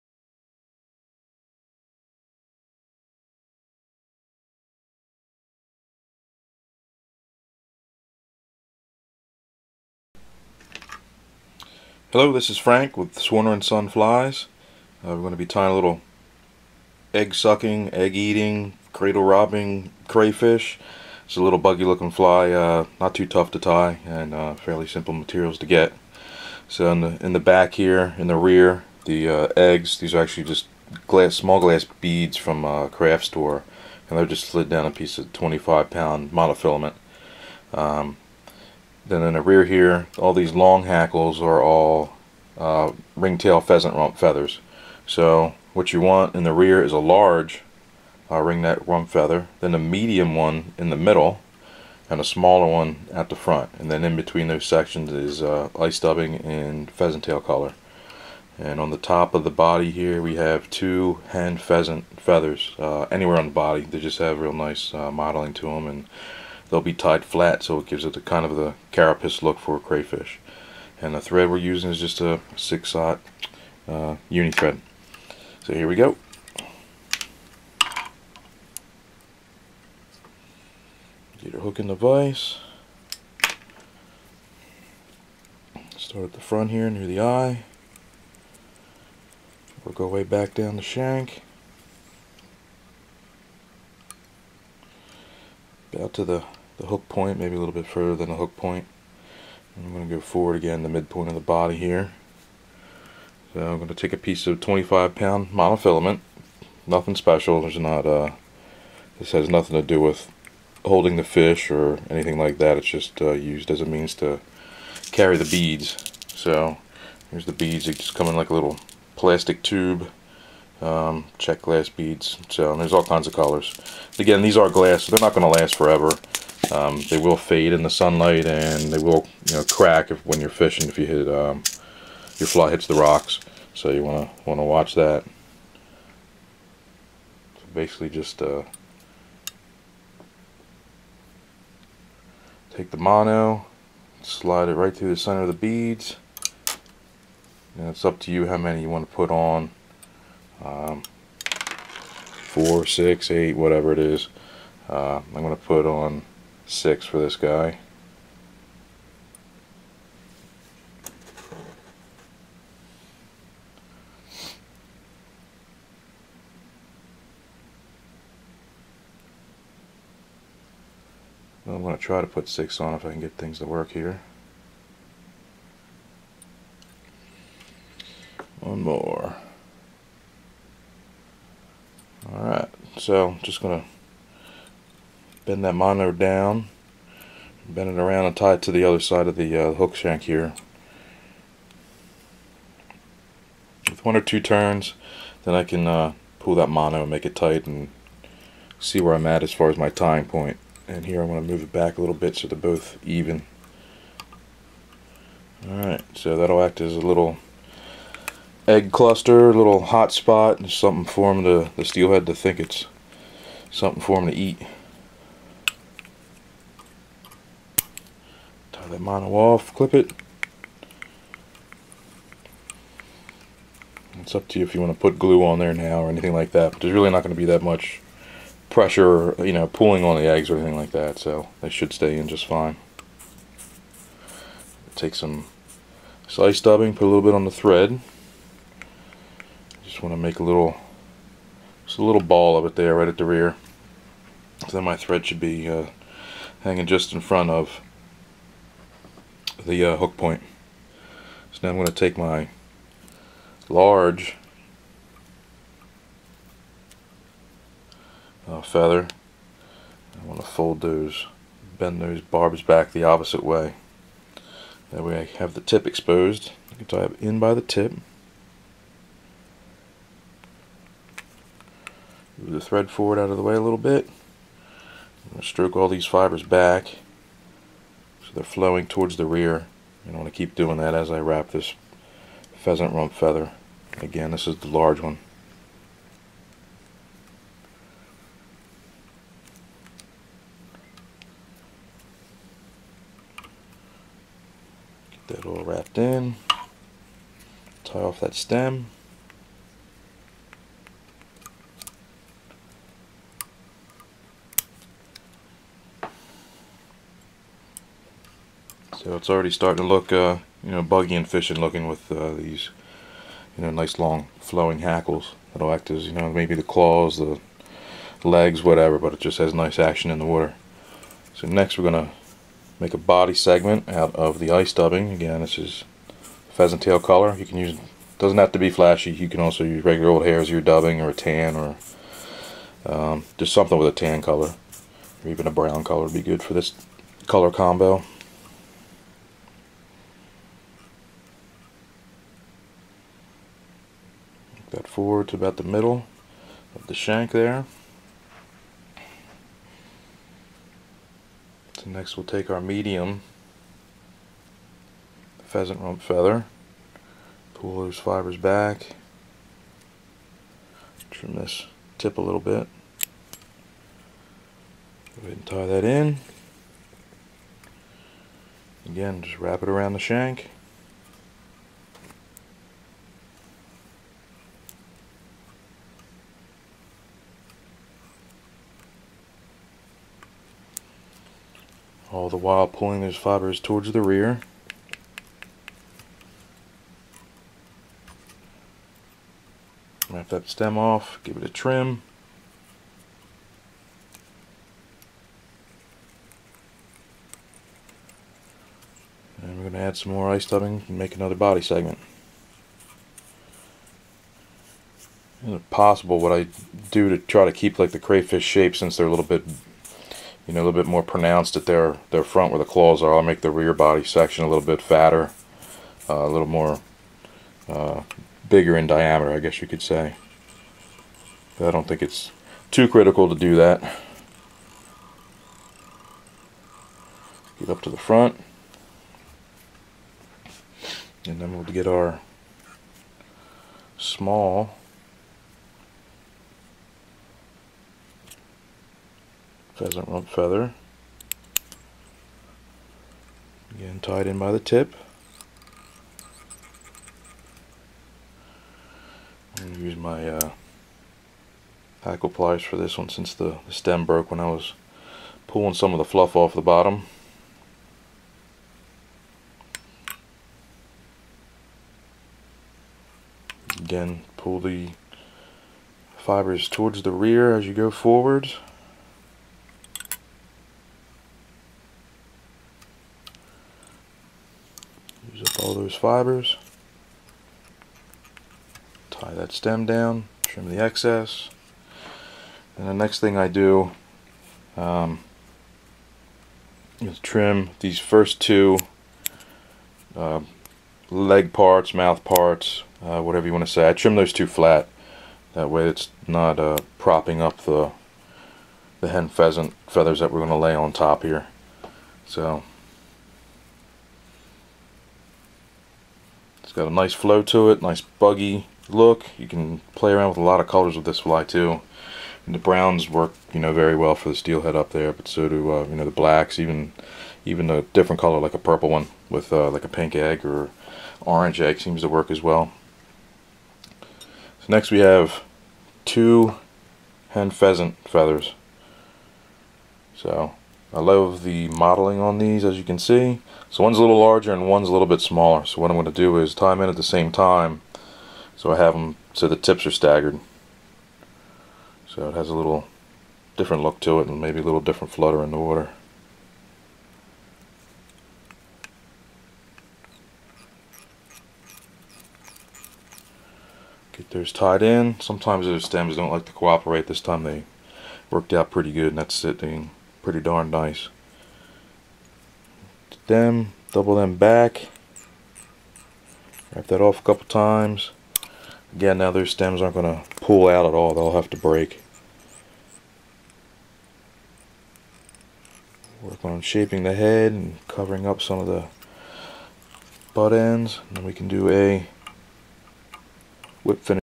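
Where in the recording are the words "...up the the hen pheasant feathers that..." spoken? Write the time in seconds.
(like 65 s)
497 s.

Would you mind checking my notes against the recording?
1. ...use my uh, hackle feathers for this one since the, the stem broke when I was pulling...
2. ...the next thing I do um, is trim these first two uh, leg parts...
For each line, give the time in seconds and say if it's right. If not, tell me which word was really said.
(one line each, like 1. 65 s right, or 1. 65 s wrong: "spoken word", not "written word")
1. 449 s wrong: "pliers", not "feathers"
2. 482 s right.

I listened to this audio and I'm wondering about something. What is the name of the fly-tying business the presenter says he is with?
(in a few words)
Swarner and Son Flies.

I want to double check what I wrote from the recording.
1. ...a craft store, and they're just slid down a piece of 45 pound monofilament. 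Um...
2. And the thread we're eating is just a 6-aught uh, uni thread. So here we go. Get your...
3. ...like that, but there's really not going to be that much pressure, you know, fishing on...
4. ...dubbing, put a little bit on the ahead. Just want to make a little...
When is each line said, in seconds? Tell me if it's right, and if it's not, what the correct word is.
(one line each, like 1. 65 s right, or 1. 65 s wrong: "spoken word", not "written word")
1. 32 s wrong: "25", not "45"
2. 71 s wrong: "using", not "eating"
3. 226 s wrong: "pulling", not "fishing"
4. 236 s wrong: "thread", not "ahead".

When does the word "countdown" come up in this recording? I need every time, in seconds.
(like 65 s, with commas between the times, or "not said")
not said.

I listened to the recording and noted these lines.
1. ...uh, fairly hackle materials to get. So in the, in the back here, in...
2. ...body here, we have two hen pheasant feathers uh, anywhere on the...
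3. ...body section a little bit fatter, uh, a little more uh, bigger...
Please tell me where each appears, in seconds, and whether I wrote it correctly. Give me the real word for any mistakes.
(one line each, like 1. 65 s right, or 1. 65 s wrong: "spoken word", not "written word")
1. 24 s wrong: "simple", not "hackle"
2. 59 s right
3. 413 s right.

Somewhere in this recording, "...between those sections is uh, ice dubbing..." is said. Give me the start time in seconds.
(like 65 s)
54 s.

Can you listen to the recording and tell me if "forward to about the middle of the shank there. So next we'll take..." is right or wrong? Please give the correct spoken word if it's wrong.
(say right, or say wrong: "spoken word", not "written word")
right.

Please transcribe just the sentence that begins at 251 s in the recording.
So now I'm going to take my large uh, feather.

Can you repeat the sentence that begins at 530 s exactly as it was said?
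So I love the mottling on these as you can see.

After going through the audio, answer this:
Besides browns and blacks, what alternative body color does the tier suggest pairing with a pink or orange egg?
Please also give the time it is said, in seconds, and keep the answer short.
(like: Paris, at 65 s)
Purple, at 518 s.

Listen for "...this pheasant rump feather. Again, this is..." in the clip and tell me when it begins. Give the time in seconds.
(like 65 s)
281 s.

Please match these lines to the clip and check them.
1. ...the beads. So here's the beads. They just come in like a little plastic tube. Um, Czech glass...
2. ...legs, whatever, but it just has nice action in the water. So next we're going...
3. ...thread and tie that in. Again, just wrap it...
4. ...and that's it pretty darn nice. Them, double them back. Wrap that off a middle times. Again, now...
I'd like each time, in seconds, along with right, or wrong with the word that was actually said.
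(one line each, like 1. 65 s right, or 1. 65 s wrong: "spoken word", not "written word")
1. 115 s right
2. 318 s right
3. 365 s wrong: "ahead", not "thread"
4. 559 s wrong: "couple", not "middle".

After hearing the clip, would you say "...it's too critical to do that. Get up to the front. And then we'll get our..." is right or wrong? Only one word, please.
right.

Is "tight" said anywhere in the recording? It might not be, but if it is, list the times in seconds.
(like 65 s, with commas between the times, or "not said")
197 s.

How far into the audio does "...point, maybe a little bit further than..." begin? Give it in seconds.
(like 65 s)
97 s.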